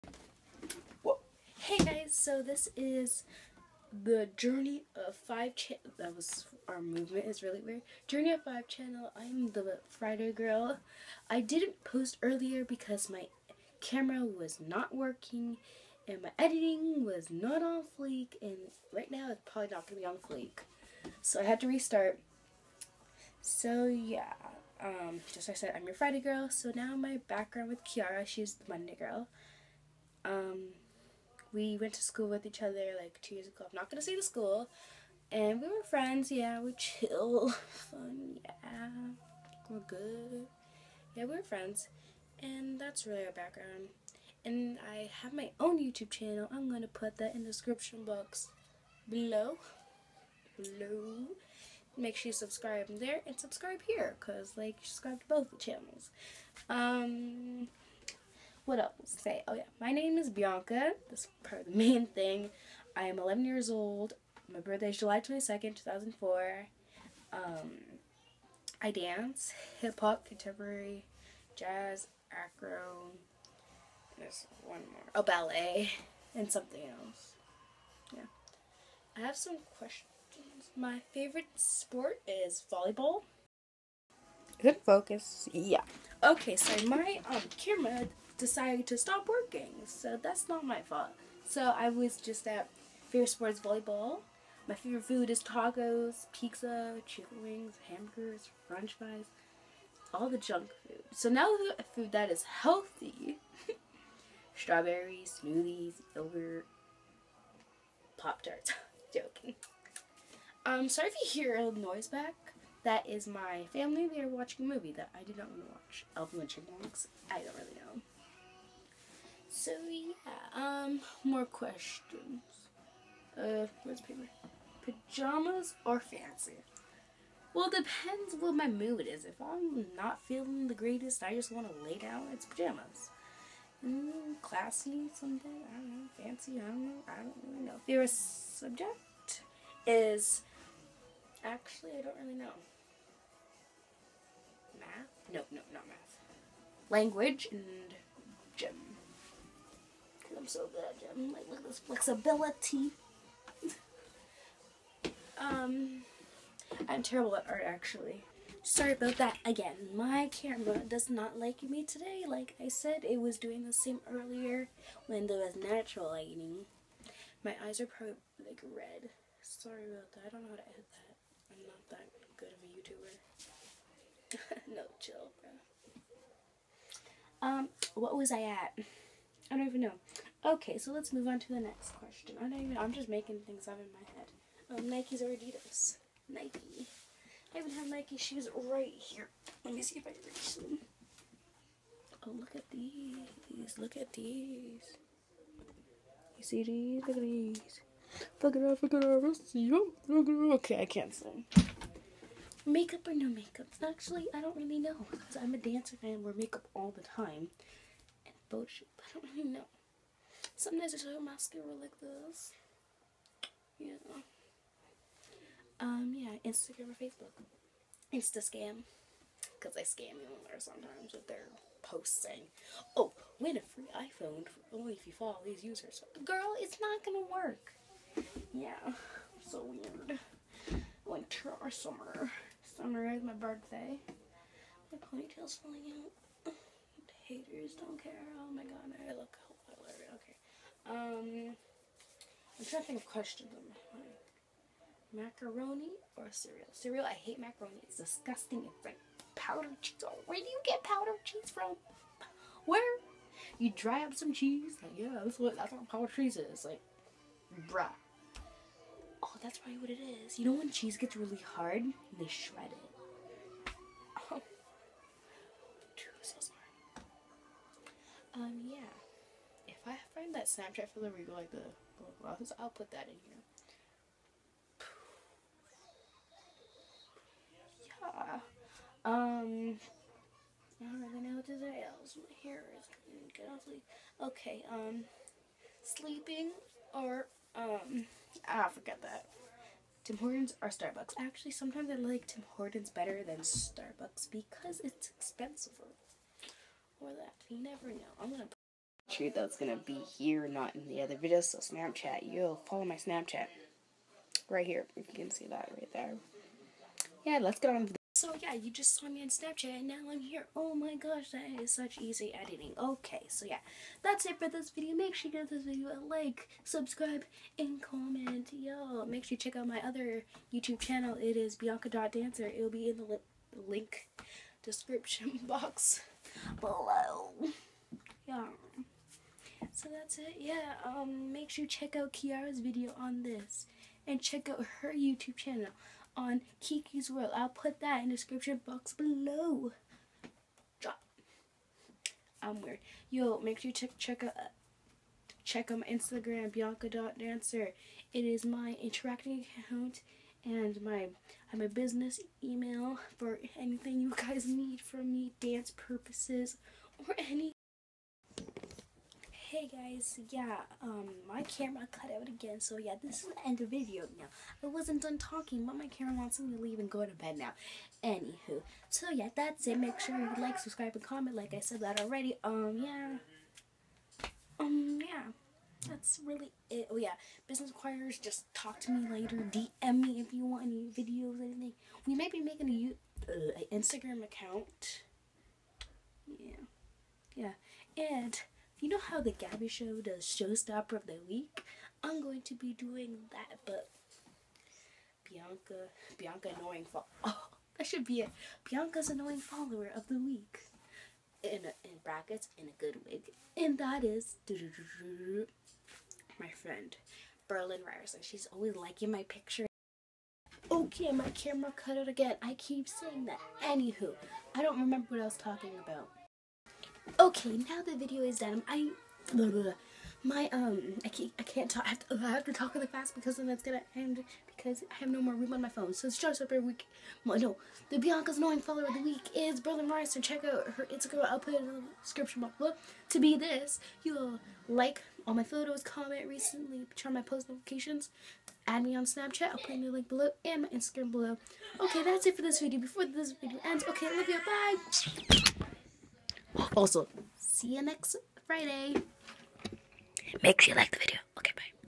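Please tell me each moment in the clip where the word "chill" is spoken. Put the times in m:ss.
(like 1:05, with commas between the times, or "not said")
0:36, 2:54.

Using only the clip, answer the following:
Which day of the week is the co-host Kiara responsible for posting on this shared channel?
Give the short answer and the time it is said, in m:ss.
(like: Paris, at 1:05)
Monday, at 0:28.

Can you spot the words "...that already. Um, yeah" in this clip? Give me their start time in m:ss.
6:11.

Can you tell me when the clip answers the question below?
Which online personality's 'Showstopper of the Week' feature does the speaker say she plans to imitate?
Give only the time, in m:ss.
6:29.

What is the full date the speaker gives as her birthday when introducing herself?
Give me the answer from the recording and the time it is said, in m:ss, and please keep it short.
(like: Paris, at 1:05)
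July 22nd, 2004, at 1:04.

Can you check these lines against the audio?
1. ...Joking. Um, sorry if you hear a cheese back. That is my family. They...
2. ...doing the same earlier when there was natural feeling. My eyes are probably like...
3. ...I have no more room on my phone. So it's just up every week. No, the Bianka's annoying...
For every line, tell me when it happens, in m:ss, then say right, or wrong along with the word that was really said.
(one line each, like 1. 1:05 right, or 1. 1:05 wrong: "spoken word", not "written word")
1. 1:49 wrong: "noise", not "cheese"
2. 2:43 wrong: "lighting", not "feeling"
3. 7:04 right.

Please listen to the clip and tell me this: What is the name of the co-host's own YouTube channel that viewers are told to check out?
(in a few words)
Kiki's World.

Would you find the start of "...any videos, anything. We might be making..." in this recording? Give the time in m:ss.
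6:20.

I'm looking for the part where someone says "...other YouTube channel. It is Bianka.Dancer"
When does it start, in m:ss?
5:19.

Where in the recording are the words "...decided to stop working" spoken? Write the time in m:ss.
1:28.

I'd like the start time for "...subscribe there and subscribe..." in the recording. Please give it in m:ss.
0:52.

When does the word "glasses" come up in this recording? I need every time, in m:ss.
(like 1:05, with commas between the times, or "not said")
4:32.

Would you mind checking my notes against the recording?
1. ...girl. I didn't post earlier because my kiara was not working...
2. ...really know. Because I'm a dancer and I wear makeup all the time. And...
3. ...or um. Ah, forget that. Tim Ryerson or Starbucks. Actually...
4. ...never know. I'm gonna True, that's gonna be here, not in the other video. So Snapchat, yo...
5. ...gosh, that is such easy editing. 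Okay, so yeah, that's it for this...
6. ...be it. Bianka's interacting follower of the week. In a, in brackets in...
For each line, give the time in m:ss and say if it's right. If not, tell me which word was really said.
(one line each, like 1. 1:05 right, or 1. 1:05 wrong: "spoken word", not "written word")
1. 0:10 wrong: "camera", not "kiara"
2. 3:24 right
3. 4:46 wrong: "Hortons", not "Ryerson"
4. 4:57 right
5. 5:10 right
6. 6:38 wrong: "annoying", not "interacting".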